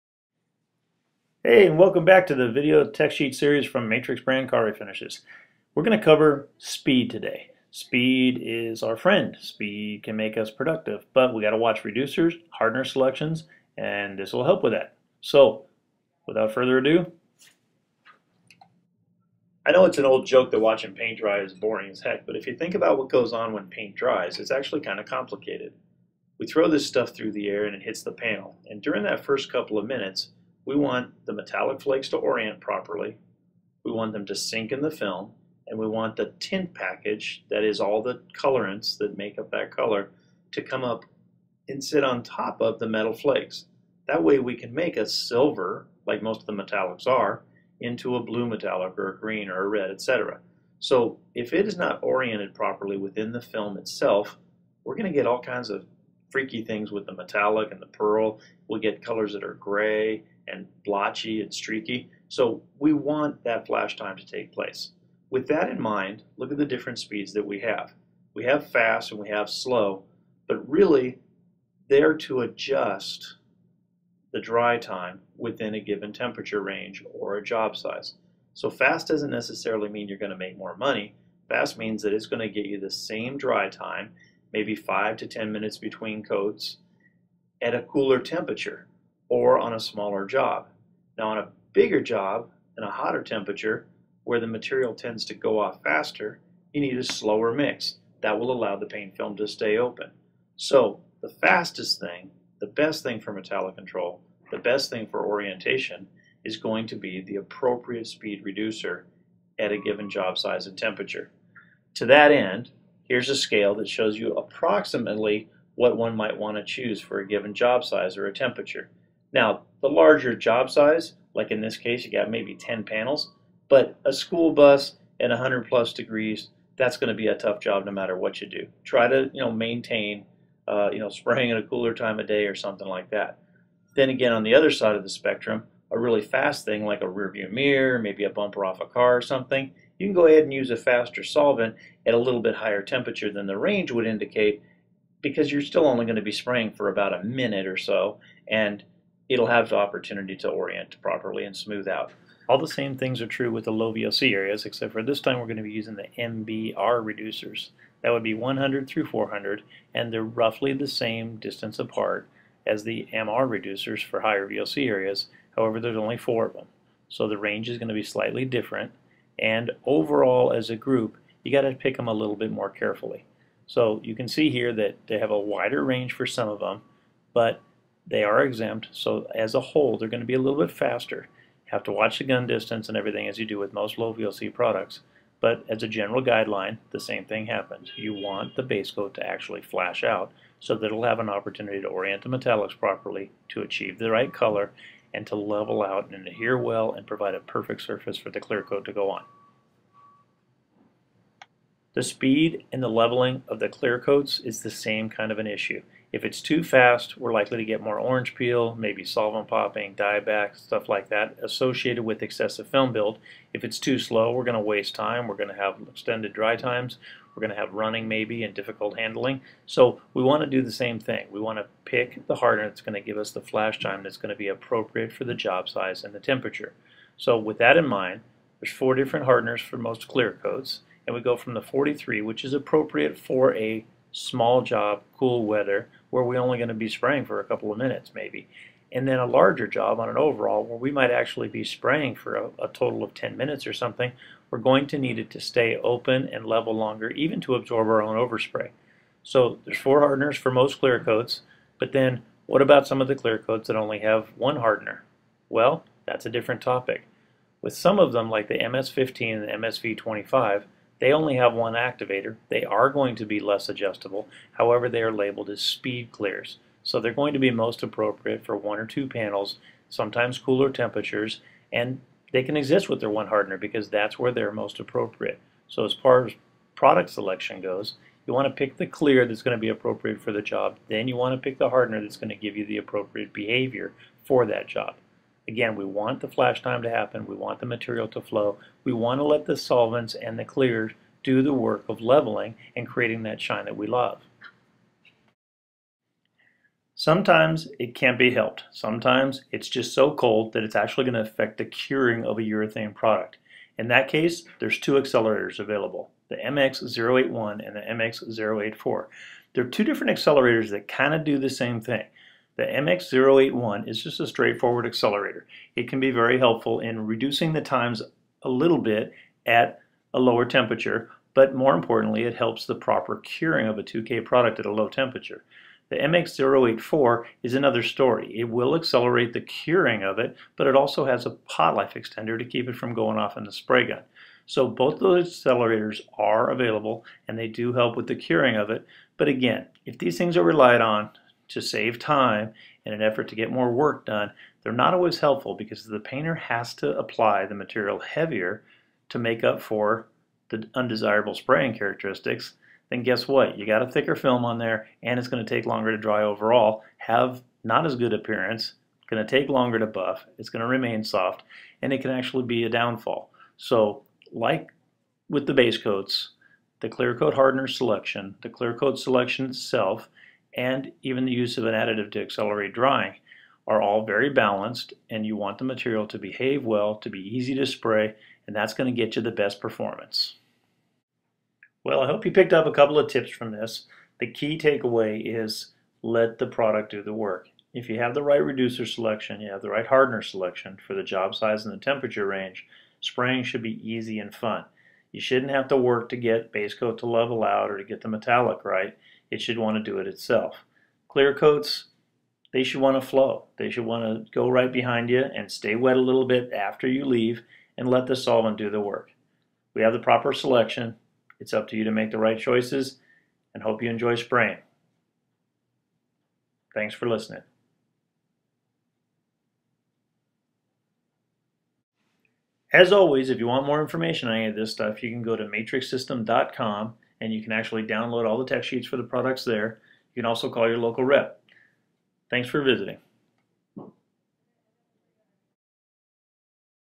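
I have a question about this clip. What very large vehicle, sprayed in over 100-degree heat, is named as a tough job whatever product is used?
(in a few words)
school bus.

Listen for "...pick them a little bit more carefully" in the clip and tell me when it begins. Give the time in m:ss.
2:51.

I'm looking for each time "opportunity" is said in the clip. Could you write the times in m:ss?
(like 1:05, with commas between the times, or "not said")
2:29, 3:11.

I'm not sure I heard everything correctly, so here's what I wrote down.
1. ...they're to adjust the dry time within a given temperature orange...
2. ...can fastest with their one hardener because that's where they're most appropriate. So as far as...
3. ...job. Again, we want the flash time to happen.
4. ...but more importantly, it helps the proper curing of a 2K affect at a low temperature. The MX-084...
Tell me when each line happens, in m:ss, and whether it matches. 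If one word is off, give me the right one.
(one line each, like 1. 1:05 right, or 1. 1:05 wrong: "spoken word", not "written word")
1. 1:11 wrong: "range", not "orange"
2. 4:32 wrong: "exist", not "fastest"
3. 4:44 right
4. 5:21 wrong: "product", not "affect".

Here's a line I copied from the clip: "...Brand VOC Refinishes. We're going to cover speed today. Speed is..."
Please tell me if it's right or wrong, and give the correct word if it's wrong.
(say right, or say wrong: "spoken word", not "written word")
wrong: "Car", not "VOC".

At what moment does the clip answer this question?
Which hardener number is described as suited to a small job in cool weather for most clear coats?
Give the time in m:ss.
3:51.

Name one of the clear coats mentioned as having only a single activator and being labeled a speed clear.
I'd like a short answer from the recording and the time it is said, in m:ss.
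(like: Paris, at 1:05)
MS-15, at 4:18.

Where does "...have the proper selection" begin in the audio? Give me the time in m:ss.
6:49.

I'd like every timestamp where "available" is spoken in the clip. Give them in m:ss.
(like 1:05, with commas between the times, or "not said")
5:05, 5:36.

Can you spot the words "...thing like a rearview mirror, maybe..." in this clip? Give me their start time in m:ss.
2:16.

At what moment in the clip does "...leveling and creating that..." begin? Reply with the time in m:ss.
4:52.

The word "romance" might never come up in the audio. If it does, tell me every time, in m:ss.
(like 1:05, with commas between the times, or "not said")
not said.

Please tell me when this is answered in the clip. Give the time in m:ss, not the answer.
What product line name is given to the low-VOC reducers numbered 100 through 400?
2:36.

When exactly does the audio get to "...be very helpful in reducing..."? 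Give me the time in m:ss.
5:16.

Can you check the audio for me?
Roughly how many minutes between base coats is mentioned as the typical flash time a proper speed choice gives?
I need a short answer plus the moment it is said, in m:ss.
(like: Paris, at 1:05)
5 to 10, at 1:24.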